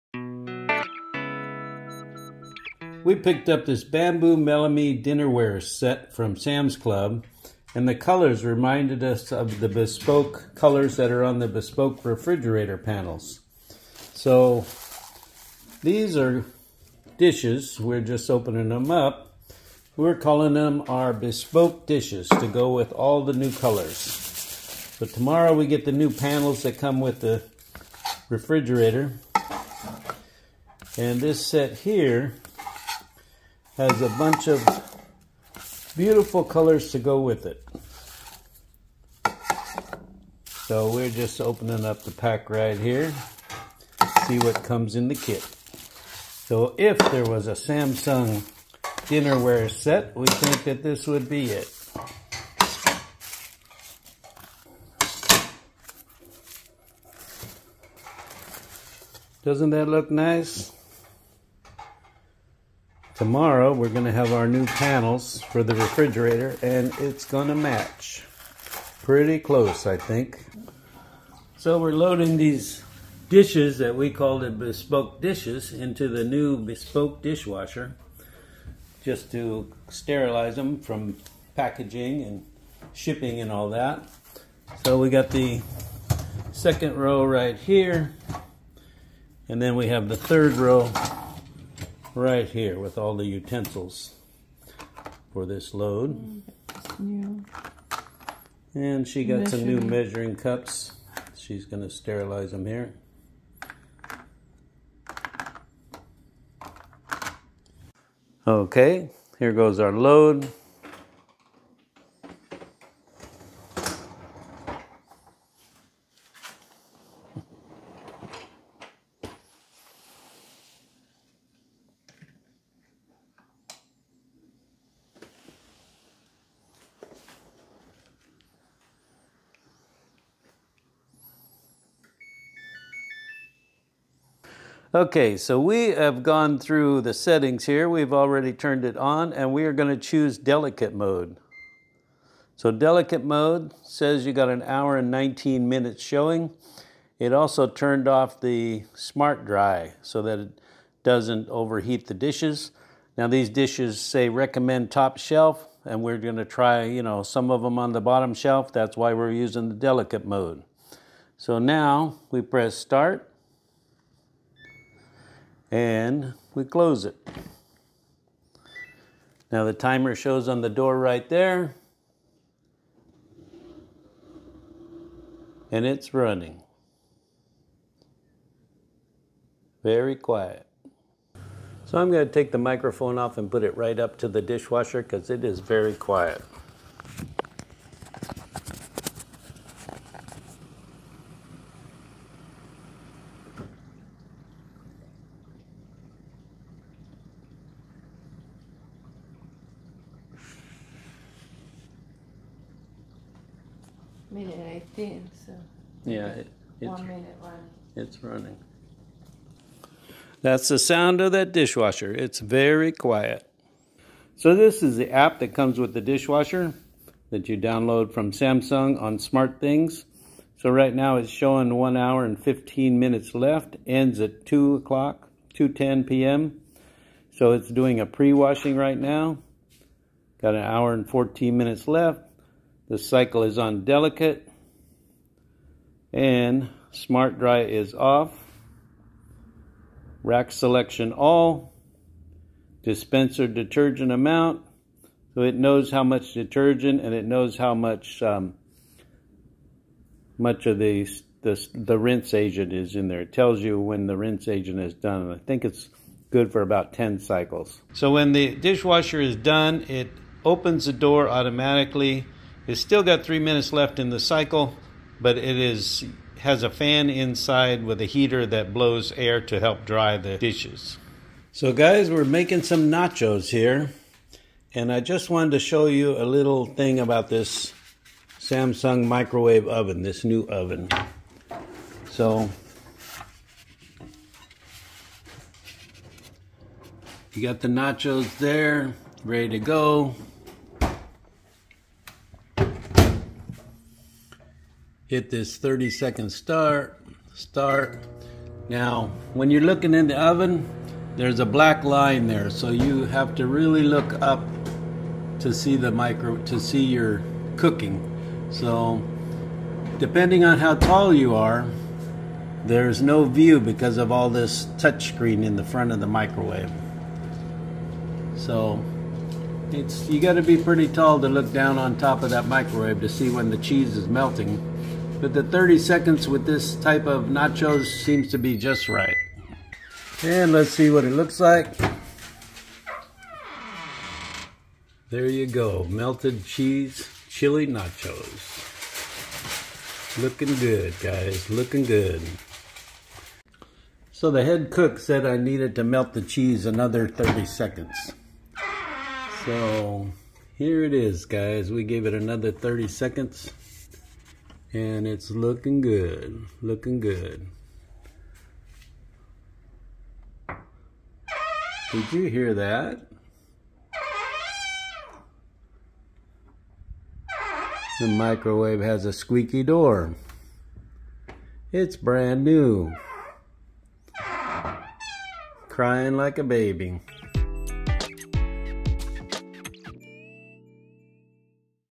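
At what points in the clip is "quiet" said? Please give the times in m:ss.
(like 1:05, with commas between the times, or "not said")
3:00, 3:05, 3:32.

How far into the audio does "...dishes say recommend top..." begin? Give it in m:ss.
2:33.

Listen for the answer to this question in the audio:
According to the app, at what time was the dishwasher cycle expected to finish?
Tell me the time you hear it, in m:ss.
3:45.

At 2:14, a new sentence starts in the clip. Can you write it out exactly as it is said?
Okay, so we have gone through the settings here.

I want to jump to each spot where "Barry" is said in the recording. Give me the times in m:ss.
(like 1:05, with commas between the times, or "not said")
not said.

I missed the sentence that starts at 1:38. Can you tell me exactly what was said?
And she got some new measuring cups.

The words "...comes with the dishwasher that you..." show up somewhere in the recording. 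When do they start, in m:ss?
3:35.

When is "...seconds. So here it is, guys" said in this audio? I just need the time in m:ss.
5:47.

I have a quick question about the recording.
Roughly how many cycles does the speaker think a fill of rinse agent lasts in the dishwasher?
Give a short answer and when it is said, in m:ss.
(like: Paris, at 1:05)
10, at 4:16.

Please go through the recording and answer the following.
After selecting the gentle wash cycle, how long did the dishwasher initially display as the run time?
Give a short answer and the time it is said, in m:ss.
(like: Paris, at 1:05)
1 hour 19 minutes, at 2:24.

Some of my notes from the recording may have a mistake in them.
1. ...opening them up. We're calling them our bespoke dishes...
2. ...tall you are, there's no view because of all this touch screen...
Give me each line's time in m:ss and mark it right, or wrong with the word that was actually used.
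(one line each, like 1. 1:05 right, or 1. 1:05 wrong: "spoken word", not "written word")
1. 0:18 right
2. 5:10 right.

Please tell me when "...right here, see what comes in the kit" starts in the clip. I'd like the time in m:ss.
0:42.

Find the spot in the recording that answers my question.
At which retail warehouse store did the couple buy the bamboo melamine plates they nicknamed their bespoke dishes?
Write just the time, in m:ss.
0:06.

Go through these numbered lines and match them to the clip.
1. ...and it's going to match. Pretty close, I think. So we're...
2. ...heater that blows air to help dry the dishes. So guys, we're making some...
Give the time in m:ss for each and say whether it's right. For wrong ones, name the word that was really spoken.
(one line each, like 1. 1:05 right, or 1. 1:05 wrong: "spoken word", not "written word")
1. 1:06 right
2. 4:28 right.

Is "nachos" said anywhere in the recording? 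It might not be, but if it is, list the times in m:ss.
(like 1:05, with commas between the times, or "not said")
4:32, 4:47, 5:27, 5:37.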